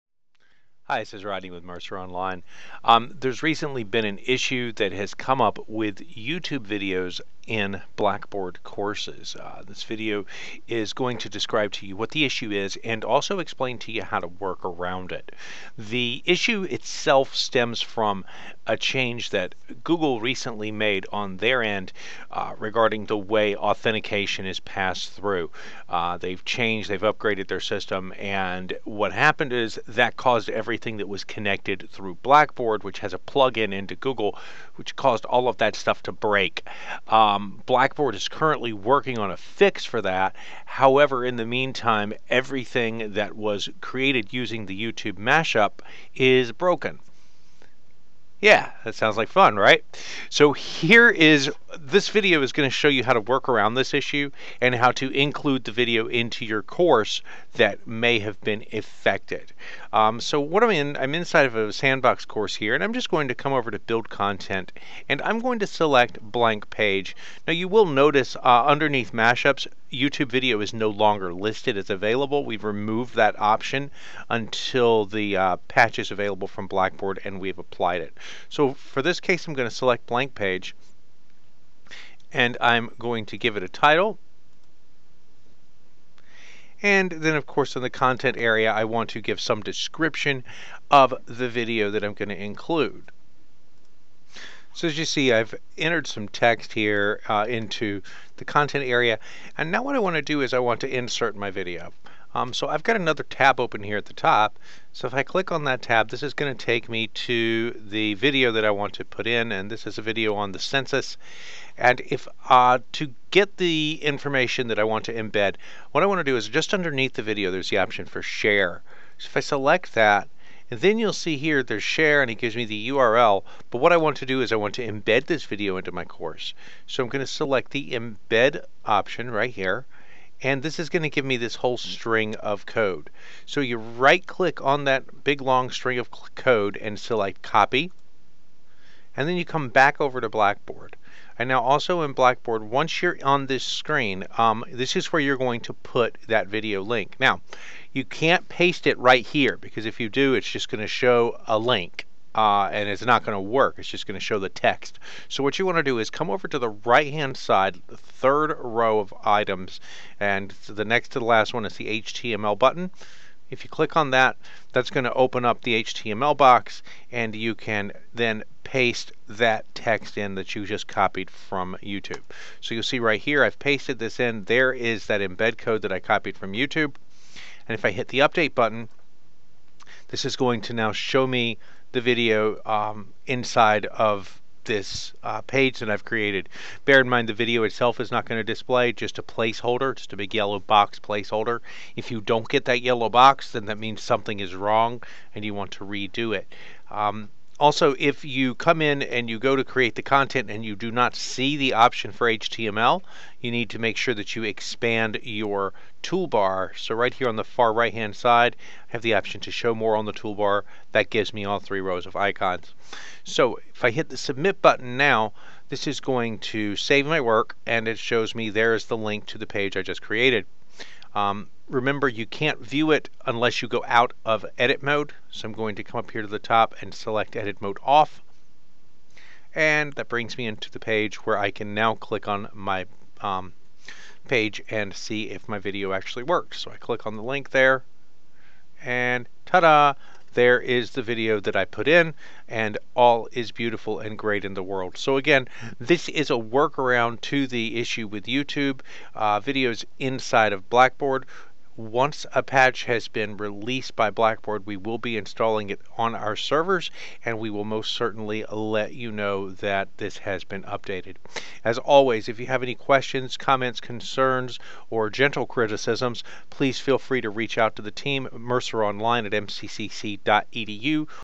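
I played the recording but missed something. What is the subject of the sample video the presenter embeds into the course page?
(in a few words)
the census.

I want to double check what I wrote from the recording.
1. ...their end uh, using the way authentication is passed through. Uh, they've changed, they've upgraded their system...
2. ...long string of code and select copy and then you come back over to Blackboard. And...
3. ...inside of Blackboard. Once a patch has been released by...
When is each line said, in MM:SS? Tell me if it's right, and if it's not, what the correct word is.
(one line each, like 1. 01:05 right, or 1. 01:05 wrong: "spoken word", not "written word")
1. 00:21 wrong: "regarding", not "using"
2. 02:15 right
3. 04:09 right.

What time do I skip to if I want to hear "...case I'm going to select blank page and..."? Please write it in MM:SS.
01:19.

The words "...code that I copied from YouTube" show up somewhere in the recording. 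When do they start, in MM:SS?
02:55.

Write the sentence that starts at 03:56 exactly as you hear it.
So I click on the link there and ta-da!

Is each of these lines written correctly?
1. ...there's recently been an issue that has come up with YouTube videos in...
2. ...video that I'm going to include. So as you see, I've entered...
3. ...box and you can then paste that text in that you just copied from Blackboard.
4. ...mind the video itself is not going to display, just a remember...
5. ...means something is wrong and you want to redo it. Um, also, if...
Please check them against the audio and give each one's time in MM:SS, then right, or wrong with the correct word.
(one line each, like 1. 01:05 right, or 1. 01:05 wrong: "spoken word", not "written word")
1. 00:03 right
2. 01:31 right
3. 02:46 wrong: "YouTube", not "Blackboard"
4. 03:07 wrong: "placeholder", not "remember"
5. 03:13 right.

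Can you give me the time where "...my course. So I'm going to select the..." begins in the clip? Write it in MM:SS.
02:05.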